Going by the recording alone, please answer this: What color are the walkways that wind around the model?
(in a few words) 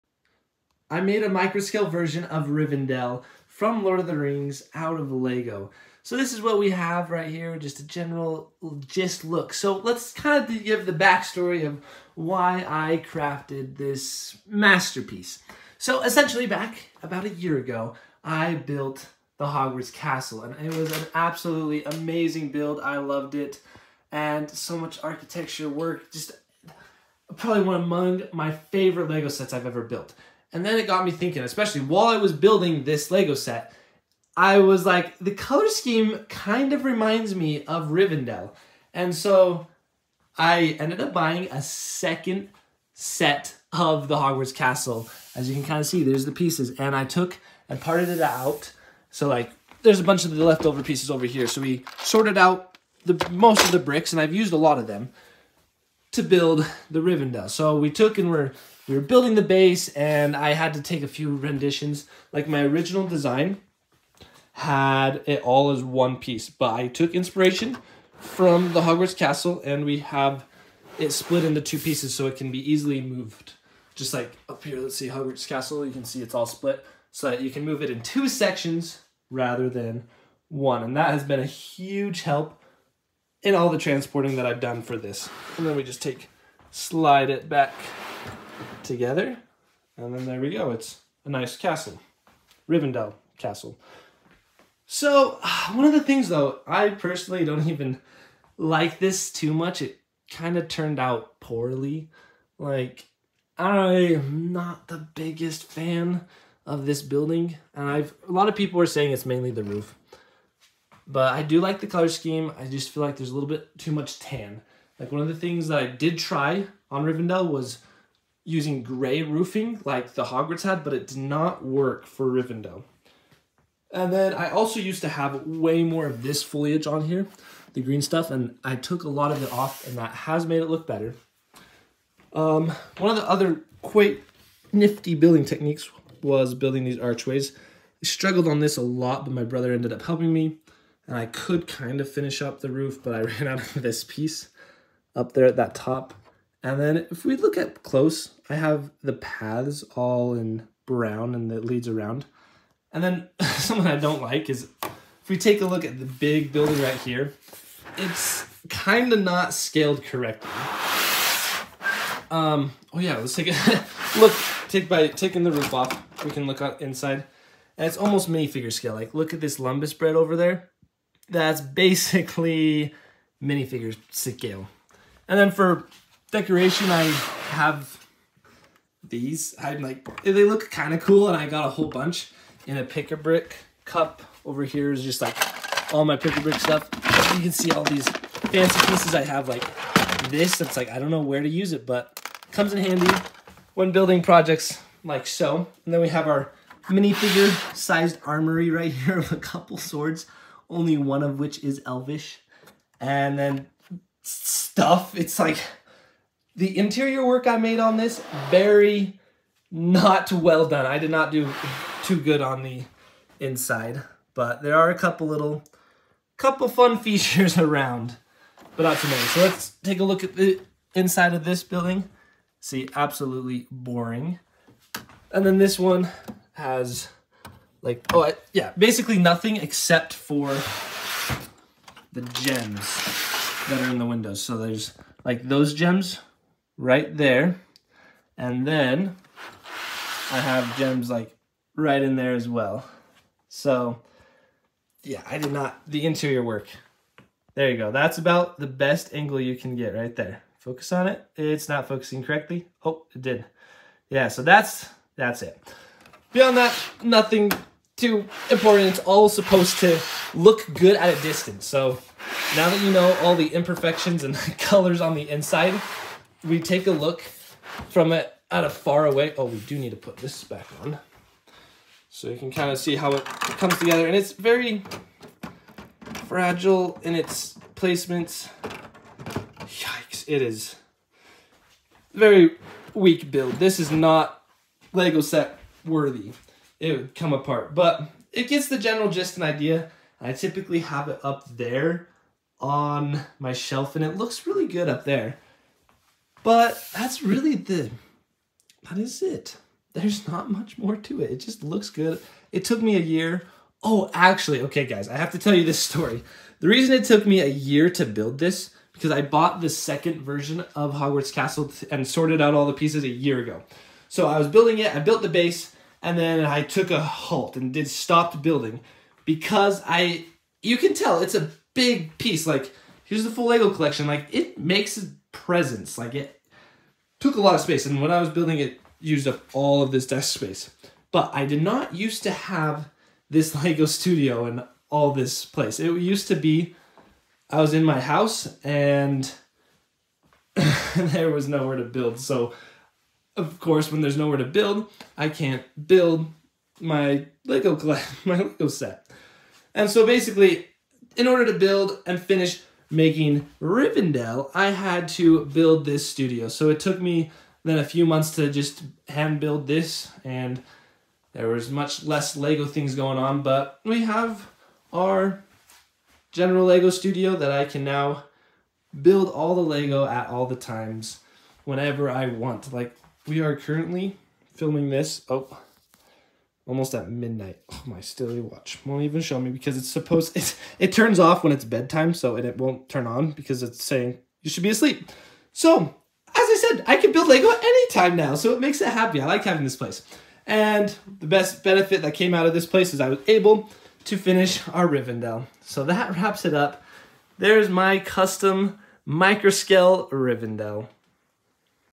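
Brown.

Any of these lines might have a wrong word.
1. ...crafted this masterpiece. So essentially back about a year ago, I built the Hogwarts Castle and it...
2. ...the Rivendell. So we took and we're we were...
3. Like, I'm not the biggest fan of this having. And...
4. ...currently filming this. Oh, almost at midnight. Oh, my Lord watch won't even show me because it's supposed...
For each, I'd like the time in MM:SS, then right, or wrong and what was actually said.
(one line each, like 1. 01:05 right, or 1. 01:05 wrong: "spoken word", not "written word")
1. 00:13 right
2. 00:56 right
3. 01:42 wrong: "building", not "having"
4. 06:13 wrong: "Stilly", not "Lord".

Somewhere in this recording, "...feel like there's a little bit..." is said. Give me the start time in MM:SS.
01:52.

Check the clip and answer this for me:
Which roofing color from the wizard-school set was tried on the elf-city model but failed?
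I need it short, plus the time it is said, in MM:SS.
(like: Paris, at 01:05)
Gray, at 01:58.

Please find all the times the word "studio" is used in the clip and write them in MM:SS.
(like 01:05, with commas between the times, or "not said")
05:33, 05:56, 06:06.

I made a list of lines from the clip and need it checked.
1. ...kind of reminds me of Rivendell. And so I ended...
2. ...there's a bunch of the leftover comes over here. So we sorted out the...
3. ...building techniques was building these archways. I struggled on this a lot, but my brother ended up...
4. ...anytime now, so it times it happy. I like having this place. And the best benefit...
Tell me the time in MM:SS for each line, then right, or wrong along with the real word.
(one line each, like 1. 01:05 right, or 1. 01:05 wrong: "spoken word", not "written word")
1. 00:36 right
2. 00:49 wrong: "pieces", not "comes"
3. 02:15 right
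4. 06:27 wrong: "makes", not "times".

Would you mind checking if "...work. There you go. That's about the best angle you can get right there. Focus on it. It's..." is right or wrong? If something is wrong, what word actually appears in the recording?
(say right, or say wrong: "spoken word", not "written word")
right.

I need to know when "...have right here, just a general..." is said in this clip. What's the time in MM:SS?
00:06.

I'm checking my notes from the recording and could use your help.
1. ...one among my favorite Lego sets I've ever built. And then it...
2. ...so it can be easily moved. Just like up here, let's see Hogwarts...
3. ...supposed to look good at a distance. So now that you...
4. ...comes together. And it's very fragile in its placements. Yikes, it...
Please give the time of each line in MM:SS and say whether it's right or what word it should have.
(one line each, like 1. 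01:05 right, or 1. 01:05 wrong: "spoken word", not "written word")
1. 00:27 right
2. 01:12 right
3. 04:19 right
4. 04:33 right.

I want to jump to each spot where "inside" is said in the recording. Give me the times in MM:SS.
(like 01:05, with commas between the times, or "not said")
02:46, 03:33, 03:40, 04:25.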